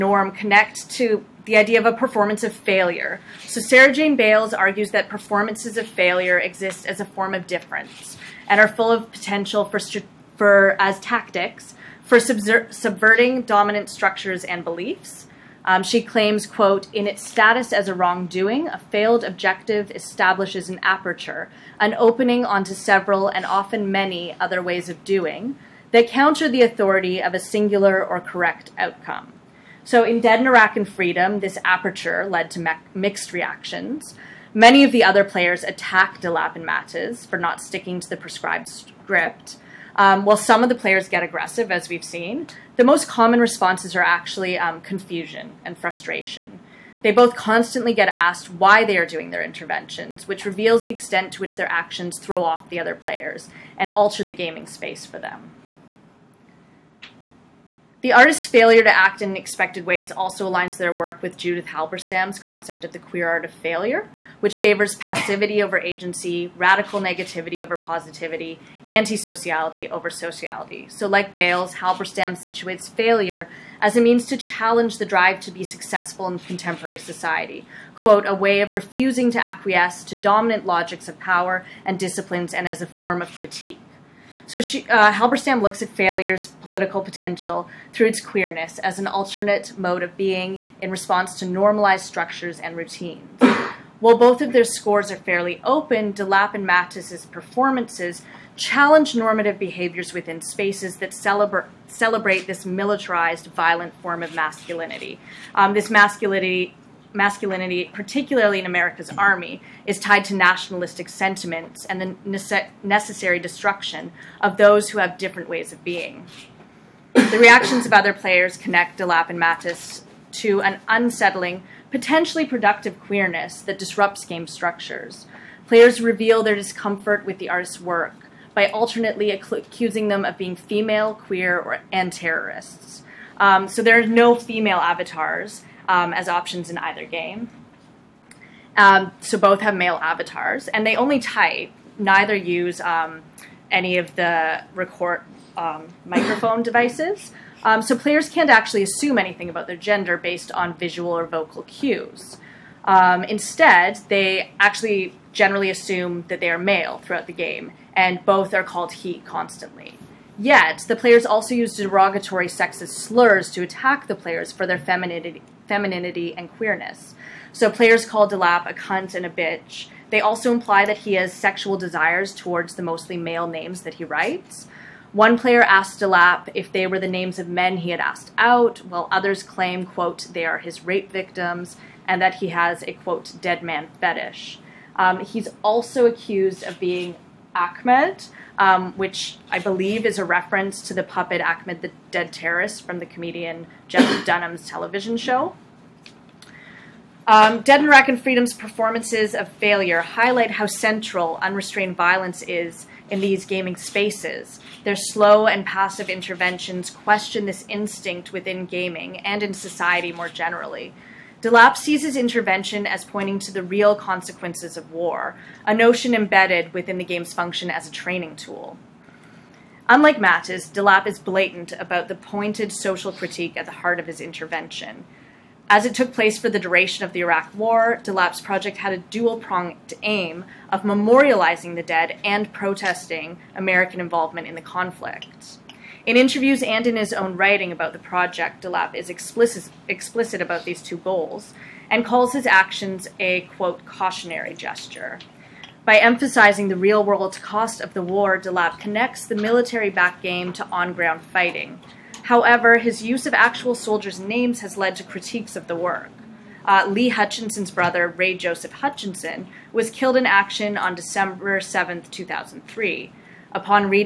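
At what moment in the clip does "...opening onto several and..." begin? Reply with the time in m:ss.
0:21.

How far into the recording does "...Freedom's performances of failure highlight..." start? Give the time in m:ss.
3:18.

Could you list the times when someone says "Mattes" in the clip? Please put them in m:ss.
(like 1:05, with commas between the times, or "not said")
0:36, 1:36, 1:59, 3:40.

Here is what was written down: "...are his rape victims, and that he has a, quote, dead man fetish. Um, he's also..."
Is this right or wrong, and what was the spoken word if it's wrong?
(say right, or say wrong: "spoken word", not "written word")
right.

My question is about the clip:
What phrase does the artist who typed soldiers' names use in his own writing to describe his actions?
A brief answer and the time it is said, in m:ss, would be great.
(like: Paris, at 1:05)
cautionary gesture, at 4:03.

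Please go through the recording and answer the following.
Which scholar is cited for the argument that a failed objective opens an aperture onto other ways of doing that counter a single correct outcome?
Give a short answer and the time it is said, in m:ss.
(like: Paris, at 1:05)
Sara Jane Bailes, at 0:03.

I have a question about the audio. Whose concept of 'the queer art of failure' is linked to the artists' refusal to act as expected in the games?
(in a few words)
Judith Halberstam.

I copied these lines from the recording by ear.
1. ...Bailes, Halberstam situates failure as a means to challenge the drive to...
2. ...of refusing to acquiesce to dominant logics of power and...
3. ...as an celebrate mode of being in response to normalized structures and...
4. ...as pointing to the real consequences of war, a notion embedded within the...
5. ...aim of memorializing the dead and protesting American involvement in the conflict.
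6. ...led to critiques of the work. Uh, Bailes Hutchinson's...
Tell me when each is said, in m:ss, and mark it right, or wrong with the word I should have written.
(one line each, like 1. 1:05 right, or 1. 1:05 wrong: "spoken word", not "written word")
1. 1:11 right
2. 1:18 right
3. 1:28 wrong: "alternate", not "celebrate"
4. 3:32 right
5. 3:50 right
6. 4:14 wrong: "Lee", not "Bailes".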